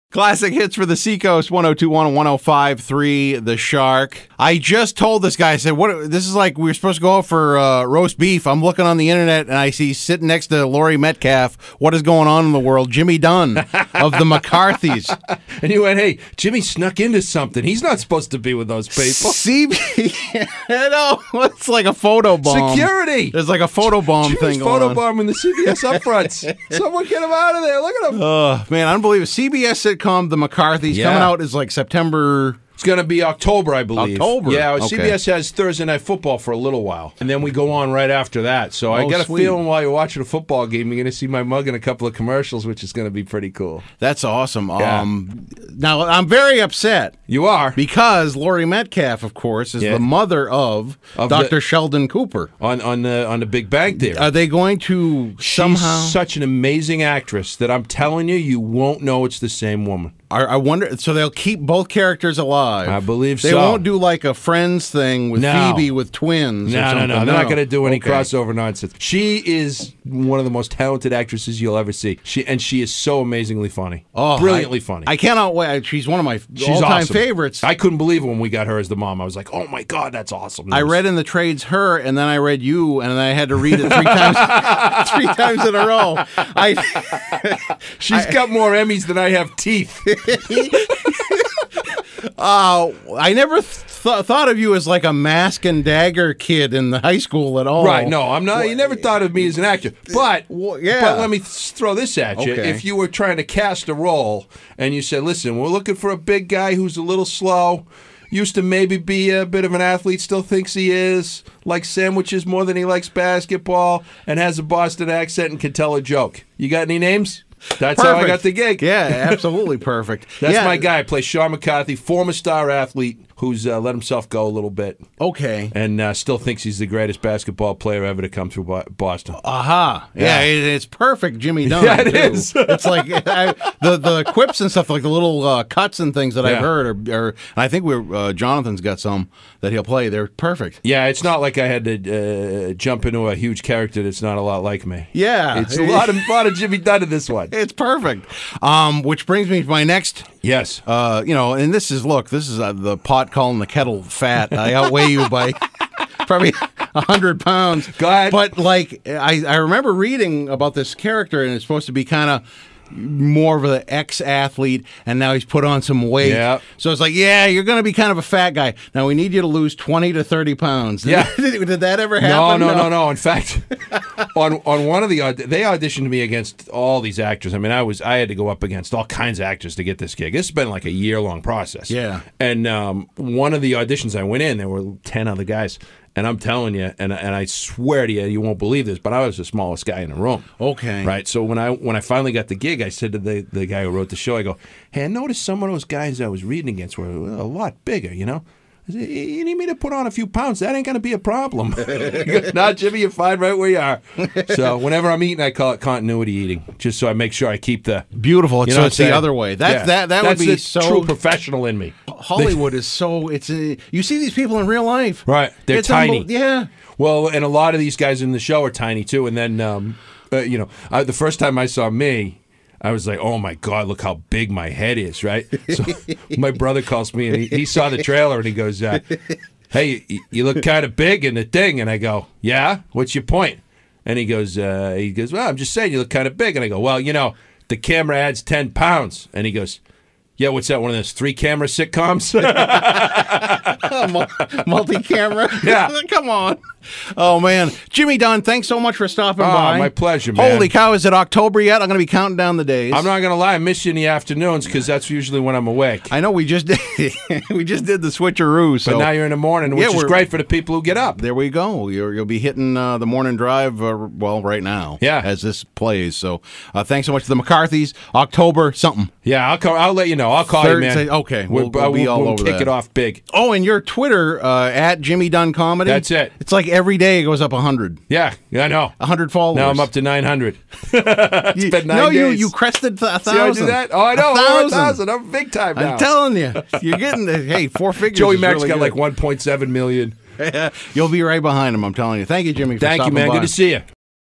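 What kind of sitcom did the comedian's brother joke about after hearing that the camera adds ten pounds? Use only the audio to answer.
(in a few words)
three camera sitcoms.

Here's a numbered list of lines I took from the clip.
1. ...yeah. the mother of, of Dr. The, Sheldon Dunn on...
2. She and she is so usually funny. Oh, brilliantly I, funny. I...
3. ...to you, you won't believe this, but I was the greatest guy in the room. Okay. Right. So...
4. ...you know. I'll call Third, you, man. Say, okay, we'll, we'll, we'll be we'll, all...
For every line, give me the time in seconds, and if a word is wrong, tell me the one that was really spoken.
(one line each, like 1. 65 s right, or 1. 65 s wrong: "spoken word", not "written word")
1. 49 s wrong: "Cooper", not "Dunn"
2. 72 s wrong: "amazingly", not "usually"
3. 188 s wrong: "smallest", not "greatest"
4. 270 s right.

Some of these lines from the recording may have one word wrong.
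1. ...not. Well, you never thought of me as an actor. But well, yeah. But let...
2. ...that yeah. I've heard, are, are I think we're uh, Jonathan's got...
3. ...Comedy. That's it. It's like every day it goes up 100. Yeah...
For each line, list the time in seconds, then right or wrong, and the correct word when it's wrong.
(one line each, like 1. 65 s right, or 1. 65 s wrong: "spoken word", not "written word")
1. 98 s right
2. 136 s right
3. 275 s right.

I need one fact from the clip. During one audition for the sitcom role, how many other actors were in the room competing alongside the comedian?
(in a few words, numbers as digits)
10.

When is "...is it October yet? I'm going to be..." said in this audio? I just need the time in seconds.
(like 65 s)
250 s.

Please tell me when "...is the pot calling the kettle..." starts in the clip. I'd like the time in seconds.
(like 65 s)
152 s.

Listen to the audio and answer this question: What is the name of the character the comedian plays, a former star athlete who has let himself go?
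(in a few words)
Sean McCarthy.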